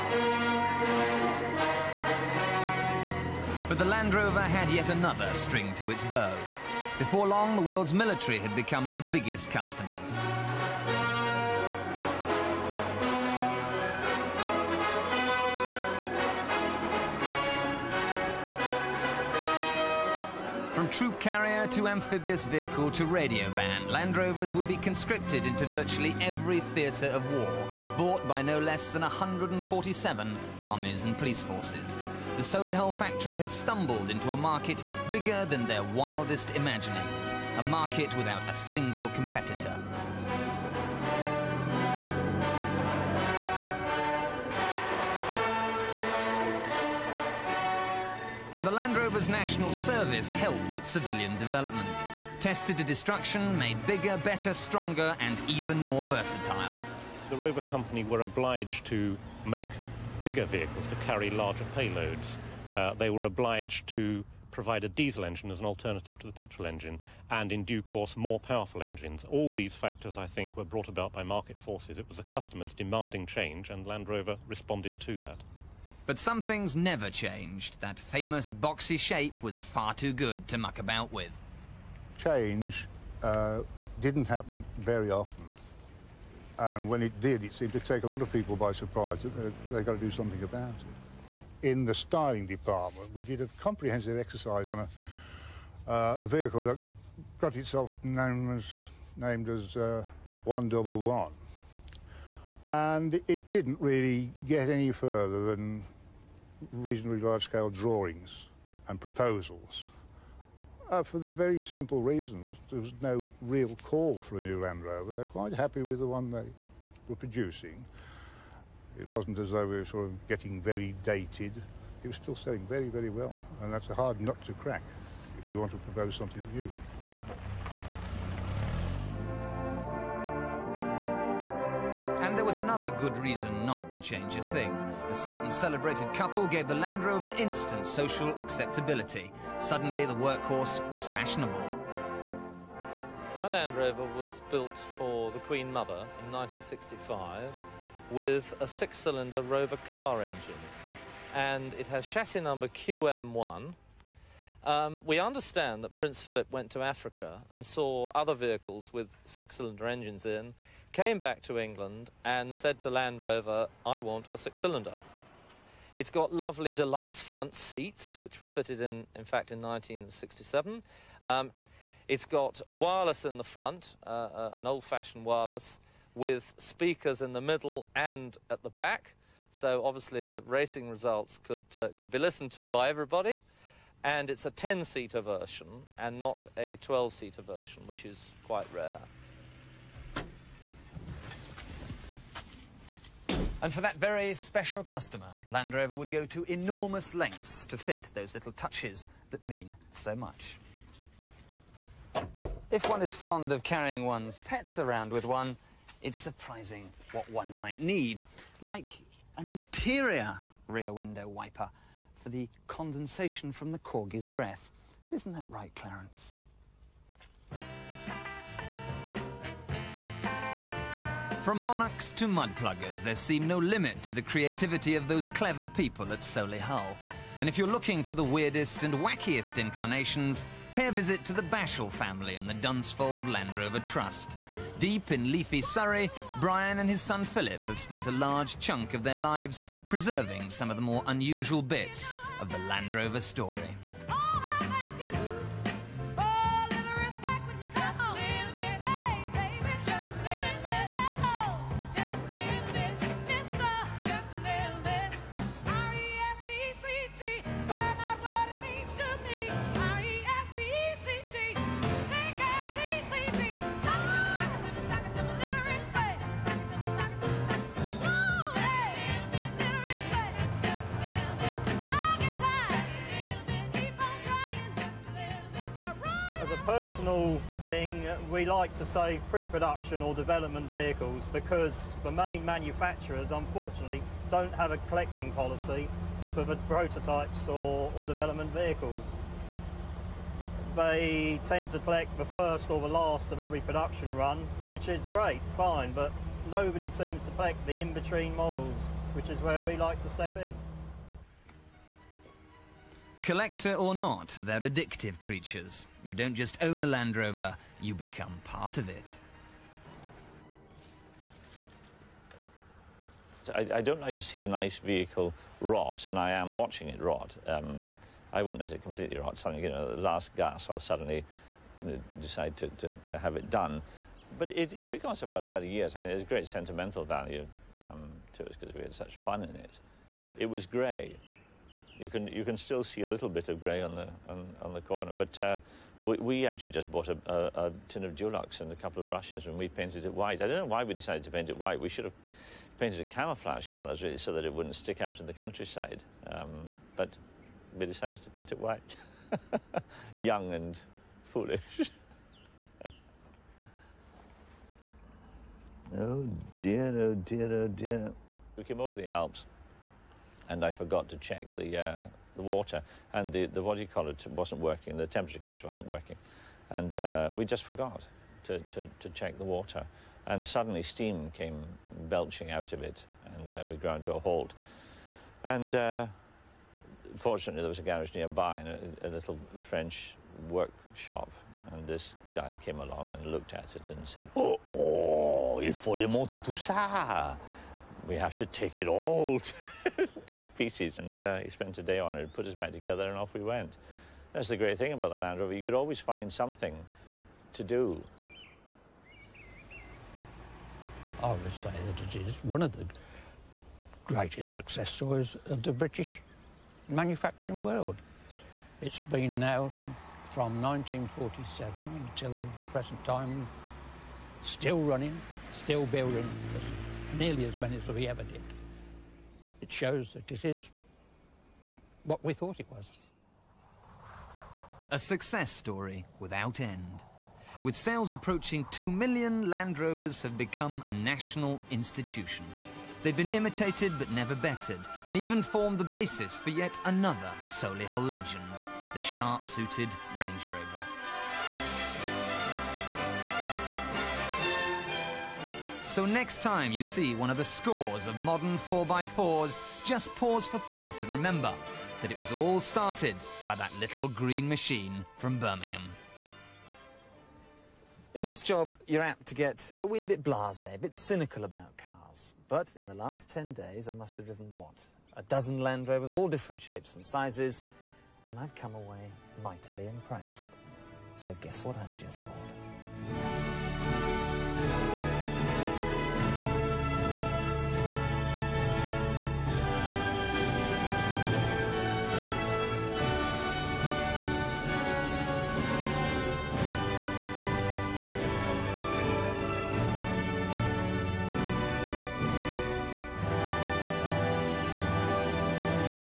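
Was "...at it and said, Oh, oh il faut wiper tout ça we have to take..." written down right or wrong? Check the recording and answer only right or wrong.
wrong.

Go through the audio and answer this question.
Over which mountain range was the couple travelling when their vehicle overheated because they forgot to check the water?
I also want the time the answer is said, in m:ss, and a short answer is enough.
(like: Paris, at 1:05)
the Alps, at 5:59.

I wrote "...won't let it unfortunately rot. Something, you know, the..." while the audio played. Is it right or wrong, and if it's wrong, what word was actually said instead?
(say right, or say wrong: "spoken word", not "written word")
wrong: "completely", not "unfortunately".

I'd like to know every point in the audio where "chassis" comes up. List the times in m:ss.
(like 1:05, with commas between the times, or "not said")
2:32.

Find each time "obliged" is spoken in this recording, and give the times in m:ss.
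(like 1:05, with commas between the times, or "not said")
0:58, 1:03.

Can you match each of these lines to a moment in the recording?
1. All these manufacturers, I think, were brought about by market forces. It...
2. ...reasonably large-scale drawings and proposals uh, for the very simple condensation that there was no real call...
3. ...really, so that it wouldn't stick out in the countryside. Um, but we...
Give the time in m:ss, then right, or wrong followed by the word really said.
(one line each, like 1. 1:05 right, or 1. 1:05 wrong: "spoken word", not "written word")
1. 1:09 wrong: "factors", not "manufacturers"
2. 1:46 wrong: "reason", not "condensation"
3. 5:44 right.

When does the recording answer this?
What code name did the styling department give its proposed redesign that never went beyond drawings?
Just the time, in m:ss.
1:40.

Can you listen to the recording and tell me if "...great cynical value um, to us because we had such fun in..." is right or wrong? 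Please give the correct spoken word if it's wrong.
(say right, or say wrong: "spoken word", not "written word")
wrong: "sentimental", not "cynical".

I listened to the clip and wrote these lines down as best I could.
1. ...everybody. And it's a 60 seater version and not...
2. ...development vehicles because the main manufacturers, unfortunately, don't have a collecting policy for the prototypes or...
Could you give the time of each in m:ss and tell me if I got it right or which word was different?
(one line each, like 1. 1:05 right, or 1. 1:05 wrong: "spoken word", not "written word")
1. 3:02 wrong: "10", not "60"
2. 4:40 right.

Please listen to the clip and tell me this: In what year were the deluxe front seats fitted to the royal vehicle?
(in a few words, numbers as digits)
1967.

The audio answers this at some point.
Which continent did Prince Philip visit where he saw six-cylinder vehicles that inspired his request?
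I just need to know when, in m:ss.
2:36.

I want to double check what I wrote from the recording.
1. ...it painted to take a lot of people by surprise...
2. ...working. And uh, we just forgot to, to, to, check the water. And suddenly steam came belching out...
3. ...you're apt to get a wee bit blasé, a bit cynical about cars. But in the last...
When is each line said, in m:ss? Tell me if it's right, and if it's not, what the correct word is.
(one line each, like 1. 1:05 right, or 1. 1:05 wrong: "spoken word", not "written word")
1. 1:27 wrong: "seemed", not "painted"
2. 6:05 right
3. 7:38 right.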